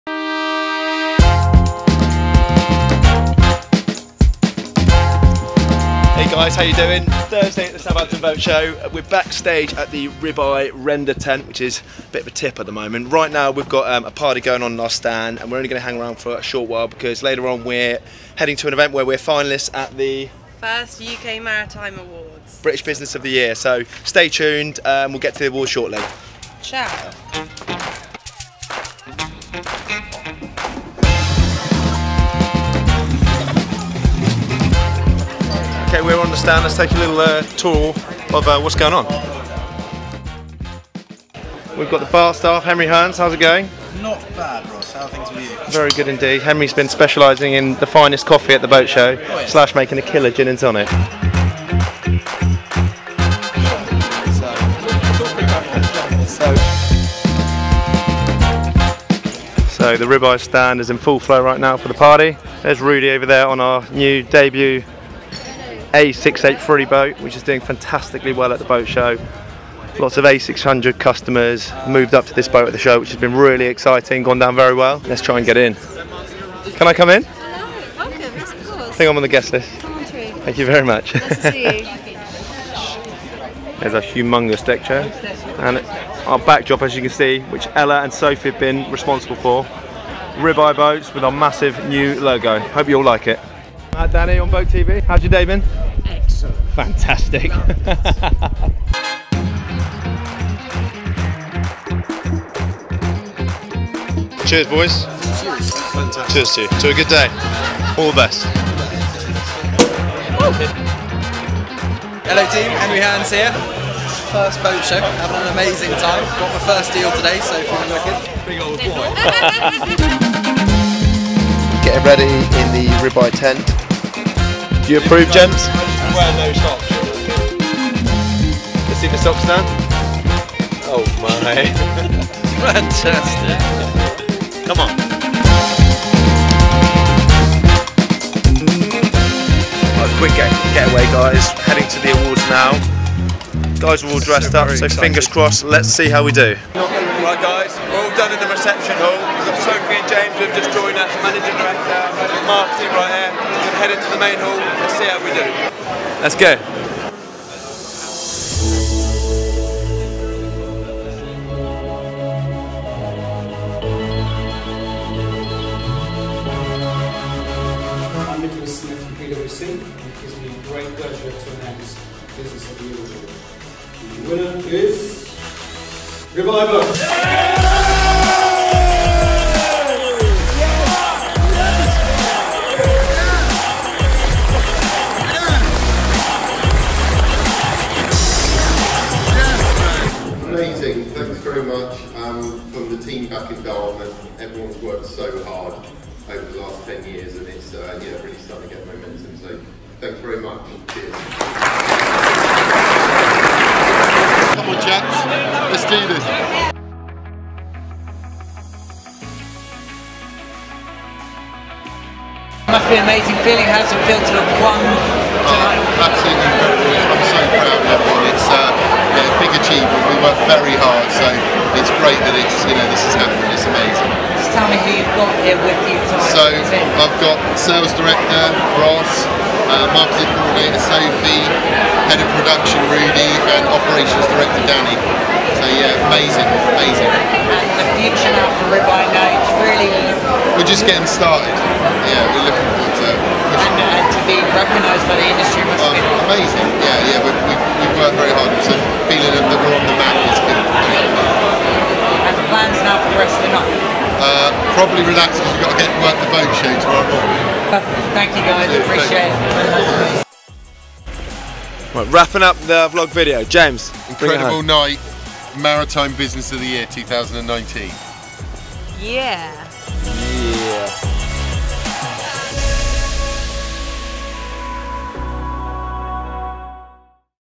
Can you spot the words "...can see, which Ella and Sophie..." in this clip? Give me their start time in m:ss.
1:27.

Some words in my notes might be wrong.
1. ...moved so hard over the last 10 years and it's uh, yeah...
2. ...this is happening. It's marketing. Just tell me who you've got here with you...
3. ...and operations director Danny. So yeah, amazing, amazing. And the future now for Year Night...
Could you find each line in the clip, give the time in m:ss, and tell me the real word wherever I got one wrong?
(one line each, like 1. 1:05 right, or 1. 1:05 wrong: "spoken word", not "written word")
1. 3:14 wrong: "worked", not "moved"
2. 3:42 wrong: "amazing", not "marketing"
3. 3:53 wrong: "Ribeye", not "Year".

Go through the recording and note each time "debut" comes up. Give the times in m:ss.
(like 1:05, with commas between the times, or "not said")
1:04.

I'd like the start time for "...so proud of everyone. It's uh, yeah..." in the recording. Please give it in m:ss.
3:37.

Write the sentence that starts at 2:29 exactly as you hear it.
Sophie and James have just joined us, managing director, marketing right here.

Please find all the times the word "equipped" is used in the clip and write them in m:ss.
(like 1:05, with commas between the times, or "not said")
not said.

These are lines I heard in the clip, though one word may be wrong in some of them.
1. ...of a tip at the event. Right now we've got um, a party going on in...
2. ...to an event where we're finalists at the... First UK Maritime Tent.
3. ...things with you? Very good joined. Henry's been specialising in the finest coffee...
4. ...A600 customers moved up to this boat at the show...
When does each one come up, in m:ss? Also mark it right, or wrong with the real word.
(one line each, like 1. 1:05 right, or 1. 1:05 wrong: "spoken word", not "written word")
1. 0:12 wrong: "moment", not "event"
2. 0:18 wrong: "Awards", not "Tent"
3. 0:45 wrong: "indeed", not "joined"
4. 1:10 right.